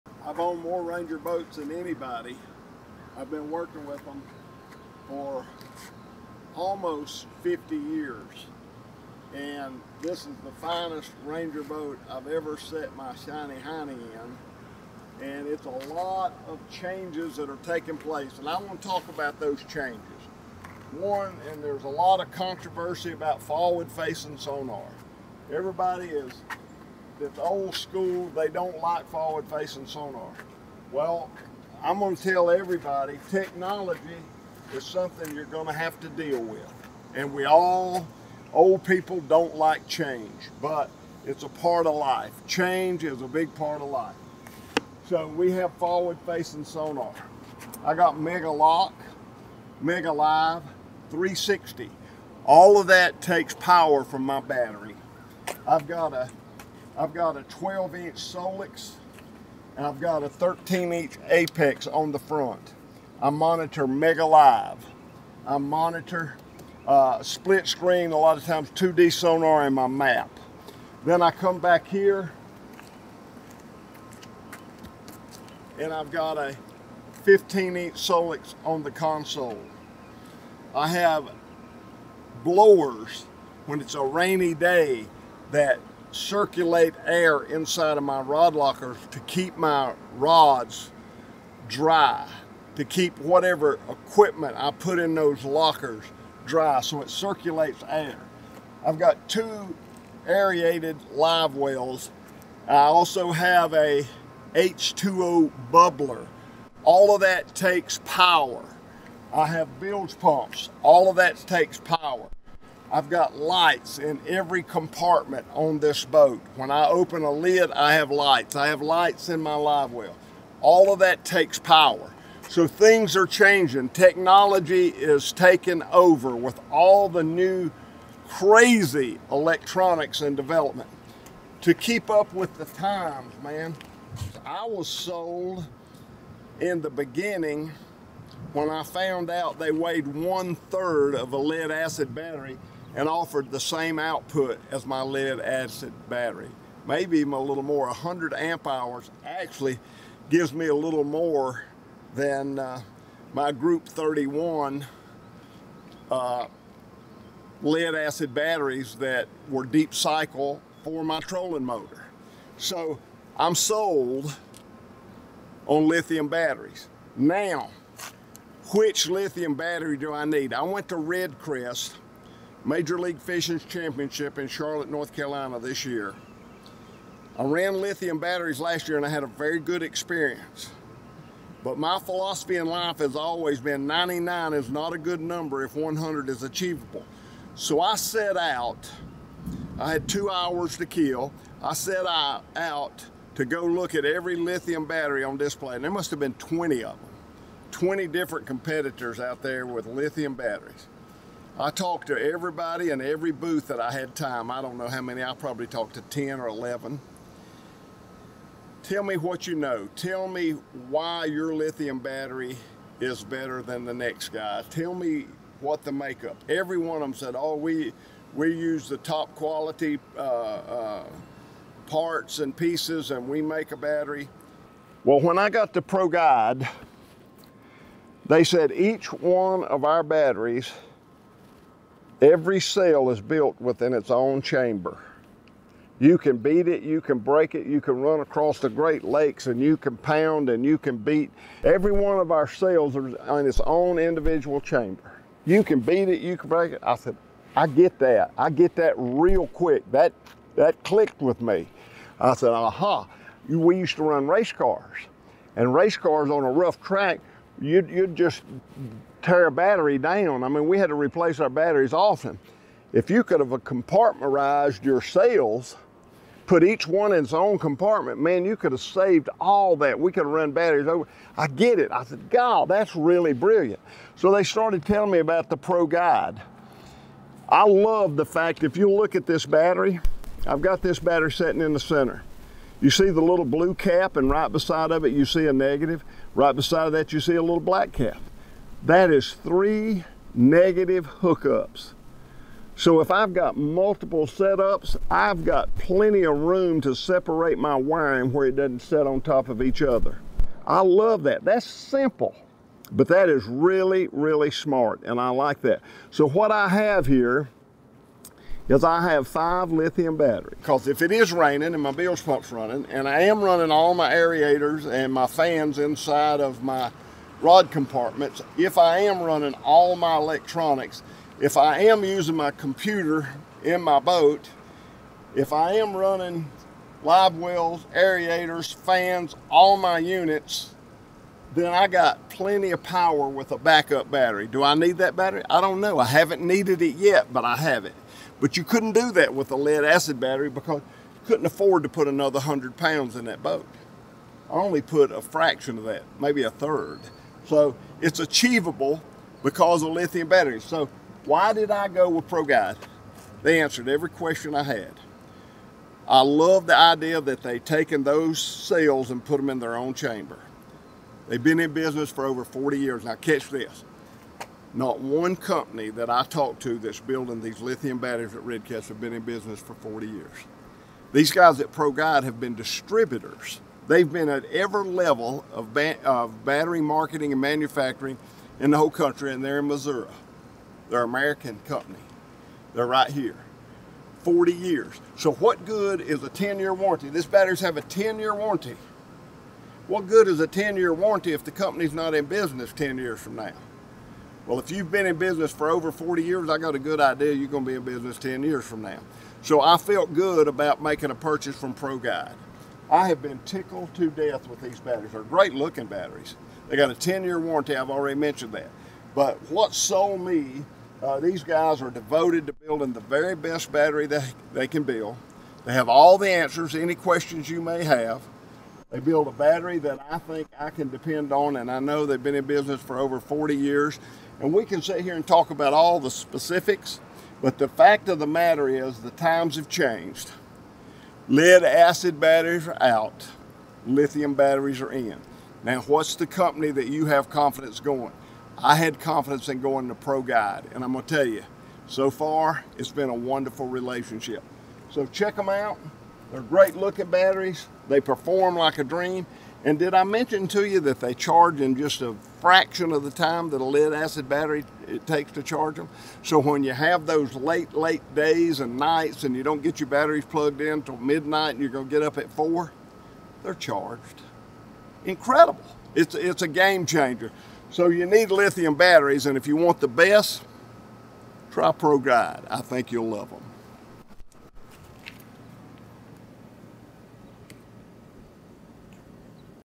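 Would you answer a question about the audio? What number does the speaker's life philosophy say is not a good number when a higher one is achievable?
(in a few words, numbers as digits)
99.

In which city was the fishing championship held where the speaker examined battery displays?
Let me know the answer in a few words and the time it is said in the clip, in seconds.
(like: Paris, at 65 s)
Charlotte, North Carolina, at 174 s.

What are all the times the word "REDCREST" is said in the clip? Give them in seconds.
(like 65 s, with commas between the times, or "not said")
170 s, 368 s.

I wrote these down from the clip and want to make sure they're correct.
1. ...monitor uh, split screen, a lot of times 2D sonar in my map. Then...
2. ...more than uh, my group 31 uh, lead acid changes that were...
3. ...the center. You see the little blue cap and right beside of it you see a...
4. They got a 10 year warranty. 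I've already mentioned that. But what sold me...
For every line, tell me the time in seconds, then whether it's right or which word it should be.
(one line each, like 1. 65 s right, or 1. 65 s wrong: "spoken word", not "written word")
1. 65 s right
2. 151 s wrong: "batteries", not "changes"
3. 281 s right
4. 406 s right.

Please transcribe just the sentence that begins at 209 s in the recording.
Tell me why your lithium battery is better than the next guy.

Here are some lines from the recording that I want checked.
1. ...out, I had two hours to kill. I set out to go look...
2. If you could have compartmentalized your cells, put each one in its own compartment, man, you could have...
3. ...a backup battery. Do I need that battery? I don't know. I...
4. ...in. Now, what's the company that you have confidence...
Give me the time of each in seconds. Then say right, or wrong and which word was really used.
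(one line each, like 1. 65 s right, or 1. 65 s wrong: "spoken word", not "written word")
1. 188 s right
2. 262 s right
3. 333 s right
4. 434 s right.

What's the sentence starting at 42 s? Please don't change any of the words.
Change is a big part of life.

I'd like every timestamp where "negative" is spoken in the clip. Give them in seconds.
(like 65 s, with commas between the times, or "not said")
285 s, 290 s.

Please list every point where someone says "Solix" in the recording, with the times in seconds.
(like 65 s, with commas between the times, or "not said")
58 s, 77 s.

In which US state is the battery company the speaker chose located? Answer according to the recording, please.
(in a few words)
Missouri.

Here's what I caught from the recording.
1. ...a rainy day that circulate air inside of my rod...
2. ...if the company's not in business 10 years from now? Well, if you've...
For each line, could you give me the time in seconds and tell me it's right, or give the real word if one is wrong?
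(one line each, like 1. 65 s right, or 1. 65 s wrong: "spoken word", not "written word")
1. 83 s right
2. 391 s right.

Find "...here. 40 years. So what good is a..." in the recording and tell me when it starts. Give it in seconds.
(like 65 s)
383 s.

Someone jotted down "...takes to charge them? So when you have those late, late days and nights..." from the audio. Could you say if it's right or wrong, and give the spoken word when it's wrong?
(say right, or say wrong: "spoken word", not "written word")
right.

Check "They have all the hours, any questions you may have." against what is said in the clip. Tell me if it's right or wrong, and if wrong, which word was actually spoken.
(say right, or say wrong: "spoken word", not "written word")
wrong: "answers", not "hours".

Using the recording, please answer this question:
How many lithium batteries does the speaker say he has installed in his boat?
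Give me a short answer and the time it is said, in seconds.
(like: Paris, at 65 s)
five, at 309 s.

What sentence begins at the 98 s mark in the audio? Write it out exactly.
I've got two aerated live wells.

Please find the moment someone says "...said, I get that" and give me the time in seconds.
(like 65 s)
246 s.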